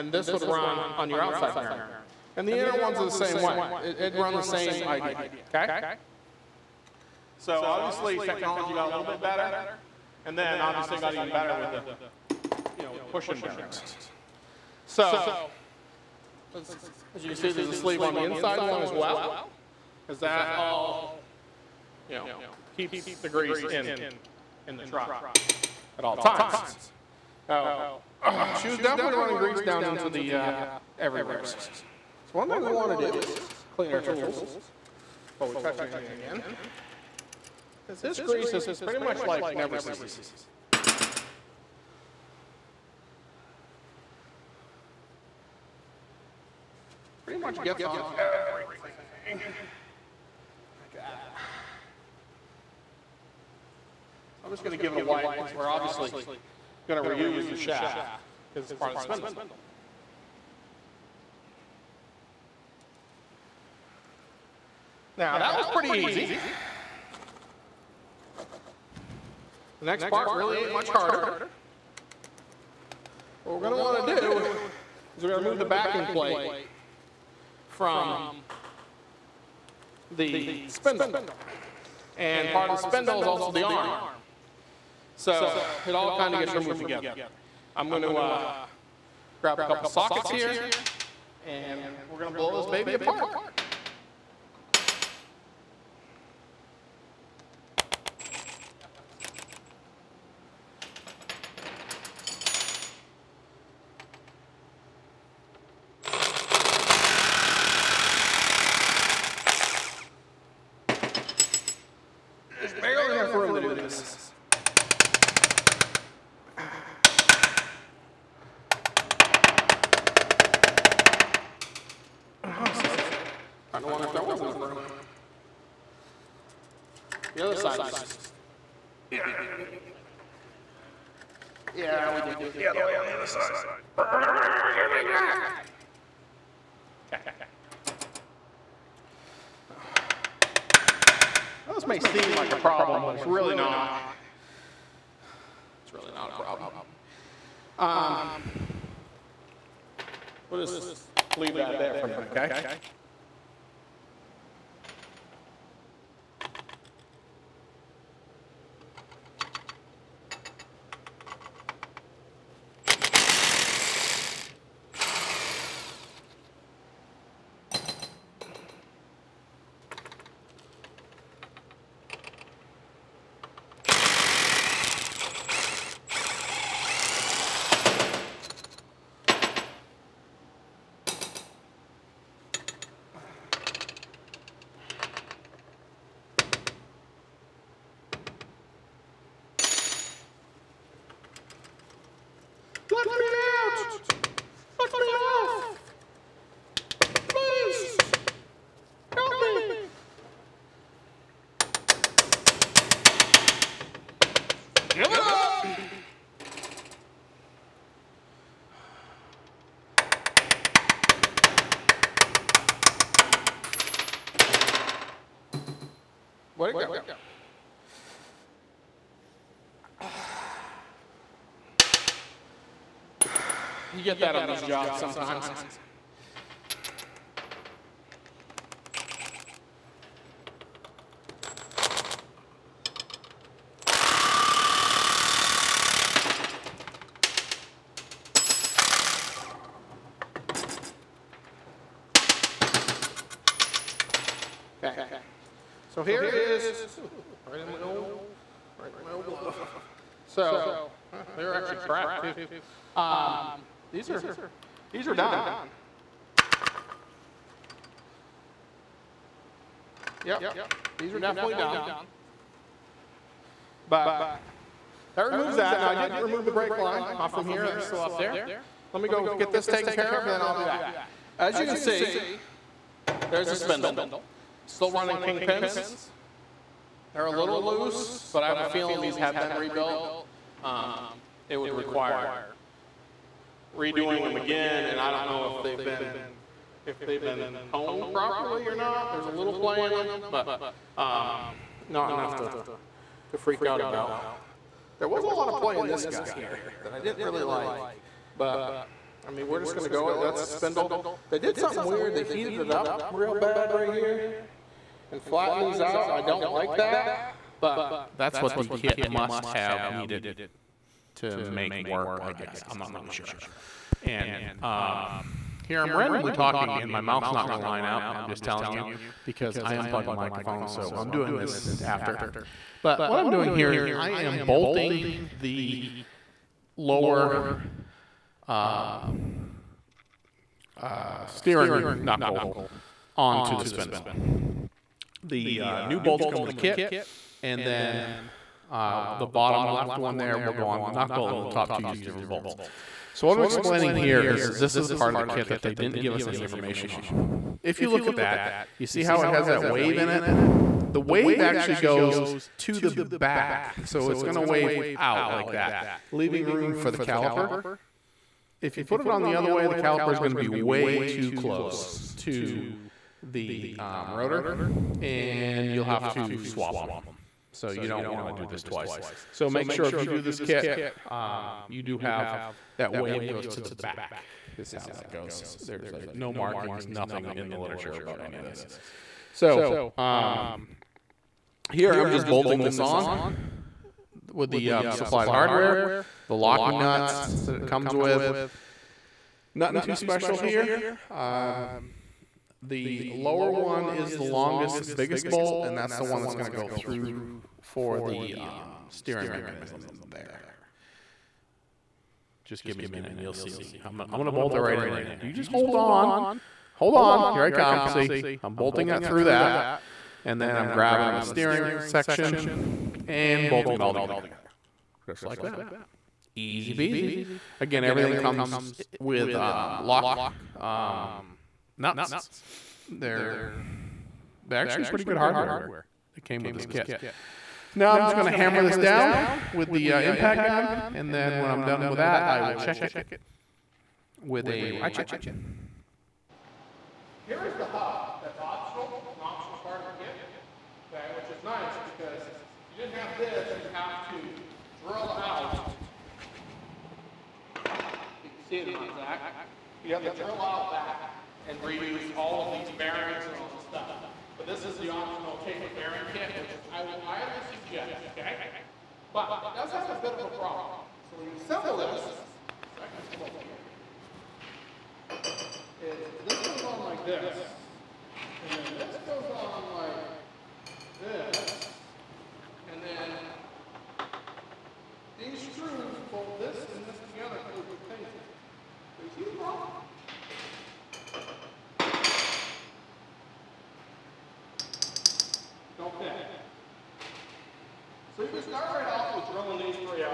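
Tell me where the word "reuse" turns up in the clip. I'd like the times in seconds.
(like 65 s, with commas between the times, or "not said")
57 s, 451 s.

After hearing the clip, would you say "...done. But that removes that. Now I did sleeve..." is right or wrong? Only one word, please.
wrong.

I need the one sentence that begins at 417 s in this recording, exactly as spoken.
Again, everything comes with um, lock um, nuts they're they're actually pretty good hardware that came with this kit.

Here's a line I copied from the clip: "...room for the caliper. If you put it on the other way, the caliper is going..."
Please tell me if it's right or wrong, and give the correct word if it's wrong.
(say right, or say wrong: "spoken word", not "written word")
right.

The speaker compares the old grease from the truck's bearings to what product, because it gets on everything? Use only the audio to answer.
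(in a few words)
Never-Seez.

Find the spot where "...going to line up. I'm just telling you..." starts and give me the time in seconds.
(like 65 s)
317 s.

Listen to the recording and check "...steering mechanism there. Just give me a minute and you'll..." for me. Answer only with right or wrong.
right.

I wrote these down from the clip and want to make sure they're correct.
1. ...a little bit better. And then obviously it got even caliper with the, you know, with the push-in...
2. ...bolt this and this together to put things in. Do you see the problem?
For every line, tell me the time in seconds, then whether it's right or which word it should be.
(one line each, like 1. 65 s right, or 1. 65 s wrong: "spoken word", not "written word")
1. 8 s wrong: "better", not "caliper"
2. 476 s right.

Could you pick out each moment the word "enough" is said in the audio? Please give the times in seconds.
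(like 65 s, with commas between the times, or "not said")
113 s, 124 s, 292 s.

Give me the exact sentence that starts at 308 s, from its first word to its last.
That's what the kit must have needed to make work, I guess.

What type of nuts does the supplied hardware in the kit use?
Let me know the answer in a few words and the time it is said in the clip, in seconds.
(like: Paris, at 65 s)
locking nuts, at 386 s.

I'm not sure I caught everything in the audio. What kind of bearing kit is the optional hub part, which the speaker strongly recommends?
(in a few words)
taper bearing kit.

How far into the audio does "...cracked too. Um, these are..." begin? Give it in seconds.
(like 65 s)
251 s.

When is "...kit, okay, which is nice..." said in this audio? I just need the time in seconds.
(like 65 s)
440 s.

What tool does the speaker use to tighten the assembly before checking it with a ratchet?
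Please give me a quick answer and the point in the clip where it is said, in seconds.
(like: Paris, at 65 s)
impact gun, at 430 s.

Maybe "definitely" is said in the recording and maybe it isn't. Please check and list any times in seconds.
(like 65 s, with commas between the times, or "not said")
28 s, 261 s.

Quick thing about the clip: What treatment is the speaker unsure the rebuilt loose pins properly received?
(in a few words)
honed.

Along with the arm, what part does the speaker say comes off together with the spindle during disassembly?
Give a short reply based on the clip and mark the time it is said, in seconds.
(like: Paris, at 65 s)
the backing plate, at 75 s.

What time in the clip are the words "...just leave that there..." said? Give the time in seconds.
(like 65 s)
150 s.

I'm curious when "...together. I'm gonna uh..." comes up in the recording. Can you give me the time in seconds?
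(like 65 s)
86 s.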